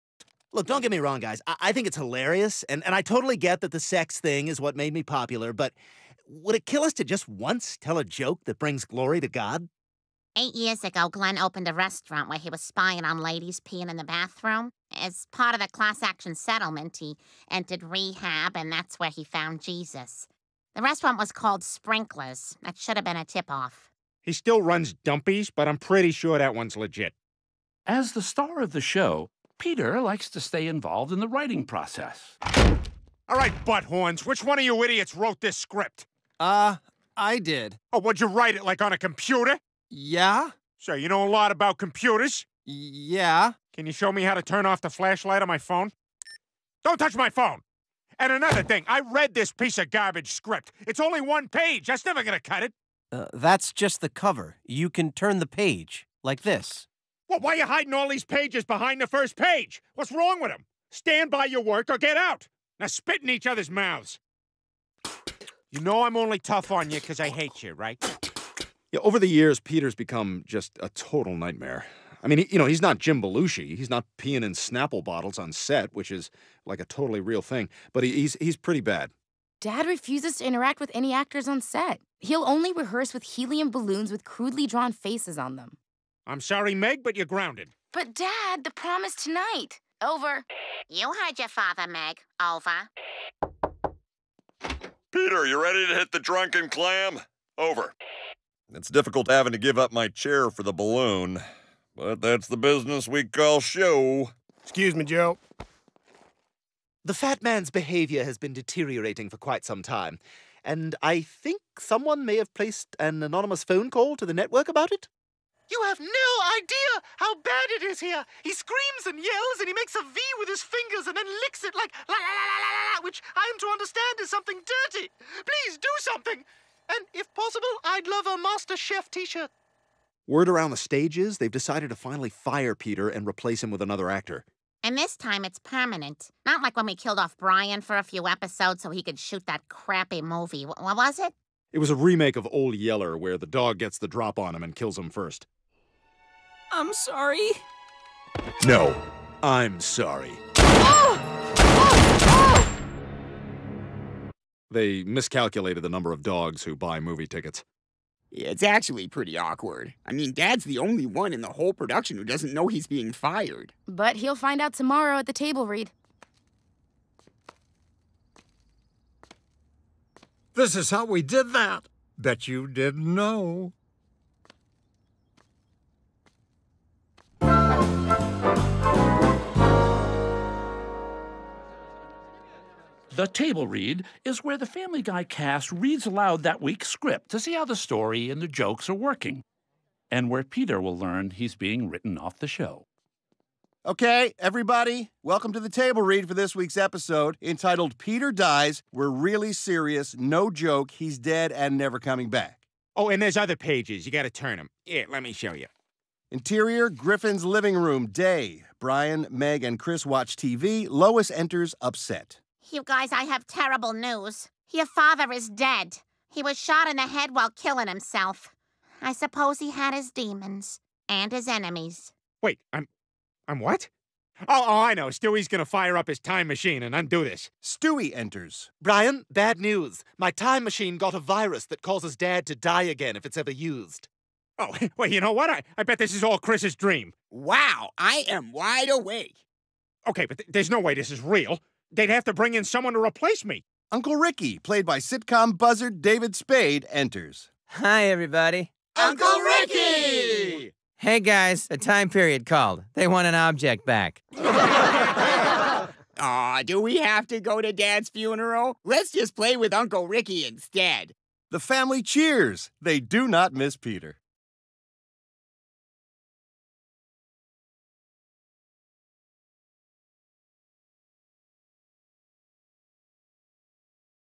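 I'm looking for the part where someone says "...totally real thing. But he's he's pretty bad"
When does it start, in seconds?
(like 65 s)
76 s.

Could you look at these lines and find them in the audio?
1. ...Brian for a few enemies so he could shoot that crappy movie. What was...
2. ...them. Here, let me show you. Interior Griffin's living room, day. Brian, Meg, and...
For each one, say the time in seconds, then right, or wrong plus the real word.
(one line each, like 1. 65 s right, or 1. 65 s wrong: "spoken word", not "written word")
1. 137 s wrong: "episodes", not "enemies"
2. 204 s right.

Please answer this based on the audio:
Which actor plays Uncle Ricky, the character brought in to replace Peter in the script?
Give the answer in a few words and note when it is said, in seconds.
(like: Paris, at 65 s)
David Spade, at 246 s.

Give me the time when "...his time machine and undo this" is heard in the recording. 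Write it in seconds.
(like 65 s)
226 s.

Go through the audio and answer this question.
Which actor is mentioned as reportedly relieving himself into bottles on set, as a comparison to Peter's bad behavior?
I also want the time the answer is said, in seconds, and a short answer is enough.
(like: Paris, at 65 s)
Jim Belushi, at 72 s.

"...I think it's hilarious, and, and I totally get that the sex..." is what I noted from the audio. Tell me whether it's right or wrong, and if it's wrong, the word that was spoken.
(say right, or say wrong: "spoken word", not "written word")
right.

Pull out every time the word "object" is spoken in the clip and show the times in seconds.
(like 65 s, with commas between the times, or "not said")
253 s.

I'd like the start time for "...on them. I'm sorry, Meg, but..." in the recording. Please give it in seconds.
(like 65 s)
85 s.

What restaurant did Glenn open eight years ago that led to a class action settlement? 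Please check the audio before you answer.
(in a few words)
Sprinklers.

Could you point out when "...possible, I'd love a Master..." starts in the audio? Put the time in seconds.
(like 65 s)
127 s.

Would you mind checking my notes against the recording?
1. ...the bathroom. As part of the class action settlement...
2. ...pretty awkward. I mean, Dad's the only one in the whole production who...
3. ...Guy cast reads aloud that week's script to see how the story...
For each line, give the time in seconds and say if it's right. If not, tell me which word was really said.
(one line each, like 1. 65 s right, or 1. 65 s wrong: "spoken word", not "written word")
1. 13 s right
2. 159 s right
3. 185 s right.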